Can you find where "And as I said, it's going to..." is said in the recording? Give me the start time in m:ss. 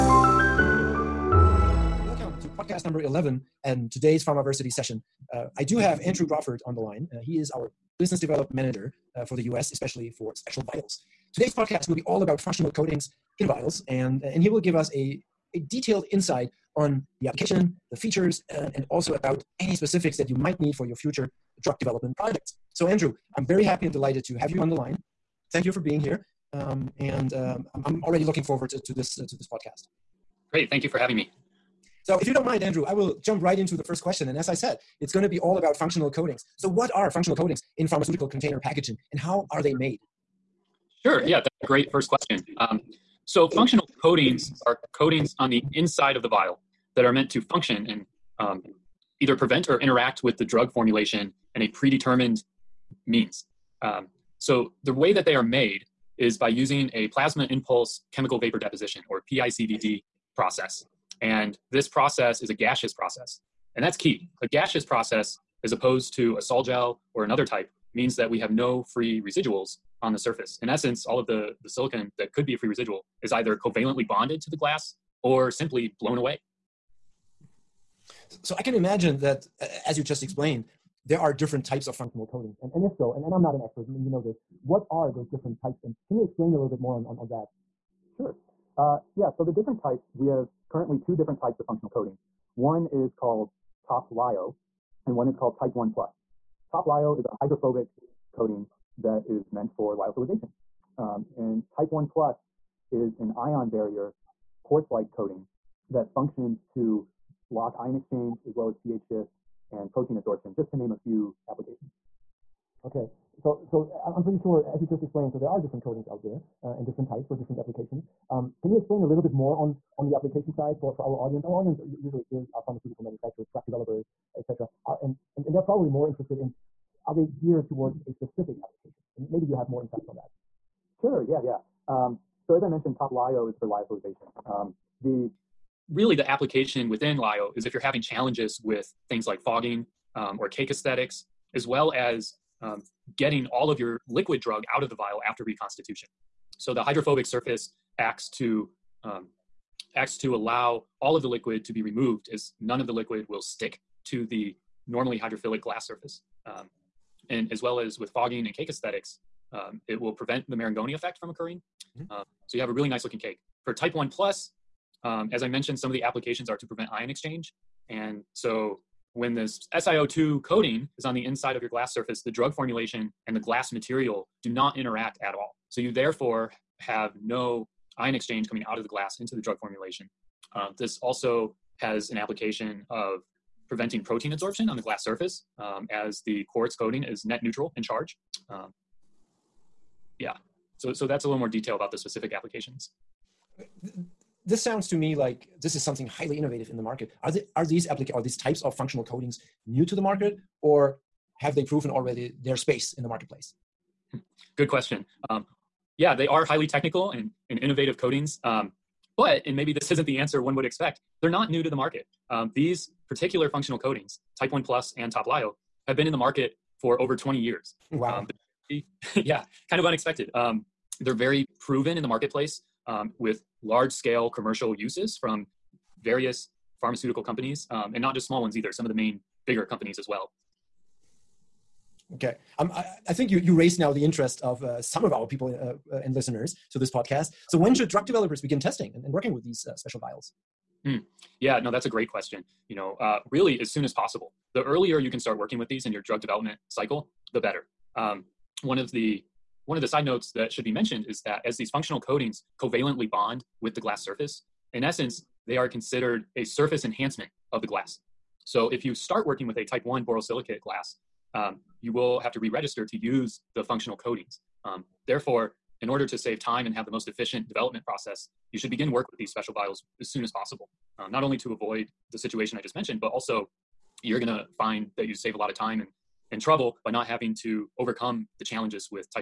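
0:34.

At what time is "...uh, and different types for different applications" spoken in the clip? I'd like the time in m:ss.
1:56.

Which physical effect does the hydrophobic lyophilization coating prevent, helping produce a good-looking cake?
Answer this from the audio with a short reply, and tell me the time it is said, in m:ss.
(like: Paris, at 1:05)
Marangoni effect, at 2:40.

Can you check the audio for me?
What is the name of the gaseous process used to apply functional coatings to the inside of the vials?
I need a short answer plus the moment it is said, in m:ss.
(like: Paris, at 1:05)
Plasma impulse chemical vapor deposition, at 0:57.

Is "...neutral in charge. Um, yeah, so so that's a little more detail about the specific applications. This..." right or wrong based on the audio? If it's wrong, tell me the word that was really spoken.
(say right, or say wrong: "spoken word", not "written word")
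right.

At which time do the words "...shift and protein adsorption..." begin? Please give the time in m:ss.
1:49.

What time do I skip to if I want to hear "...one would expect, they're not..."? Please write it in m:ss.
3:30.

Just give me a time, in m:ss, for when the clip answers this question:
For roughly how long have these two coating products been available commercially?
3:36.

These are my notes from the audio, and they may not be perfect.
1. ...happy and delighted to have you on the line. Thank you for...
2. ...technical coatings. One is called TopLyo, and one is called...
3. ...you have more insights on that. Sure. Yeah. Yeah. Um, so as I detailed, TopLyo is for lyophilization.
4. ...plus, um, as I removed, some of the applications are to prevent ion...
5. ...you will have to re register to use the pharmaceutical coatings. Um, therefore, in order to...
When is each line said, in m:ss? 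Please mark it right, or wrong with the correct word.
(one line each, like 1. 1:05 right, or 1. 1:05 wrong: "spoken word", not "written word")
1. 0:23 right
2. 1:31 wrong: "functional", not "technical"
3. 2:09 wrong: "mentioned", not "detailed"
4. 2:44 wrong: "mentioned", not "removed"
5. 4:21 wrong: "functional", not "pharmaceutical".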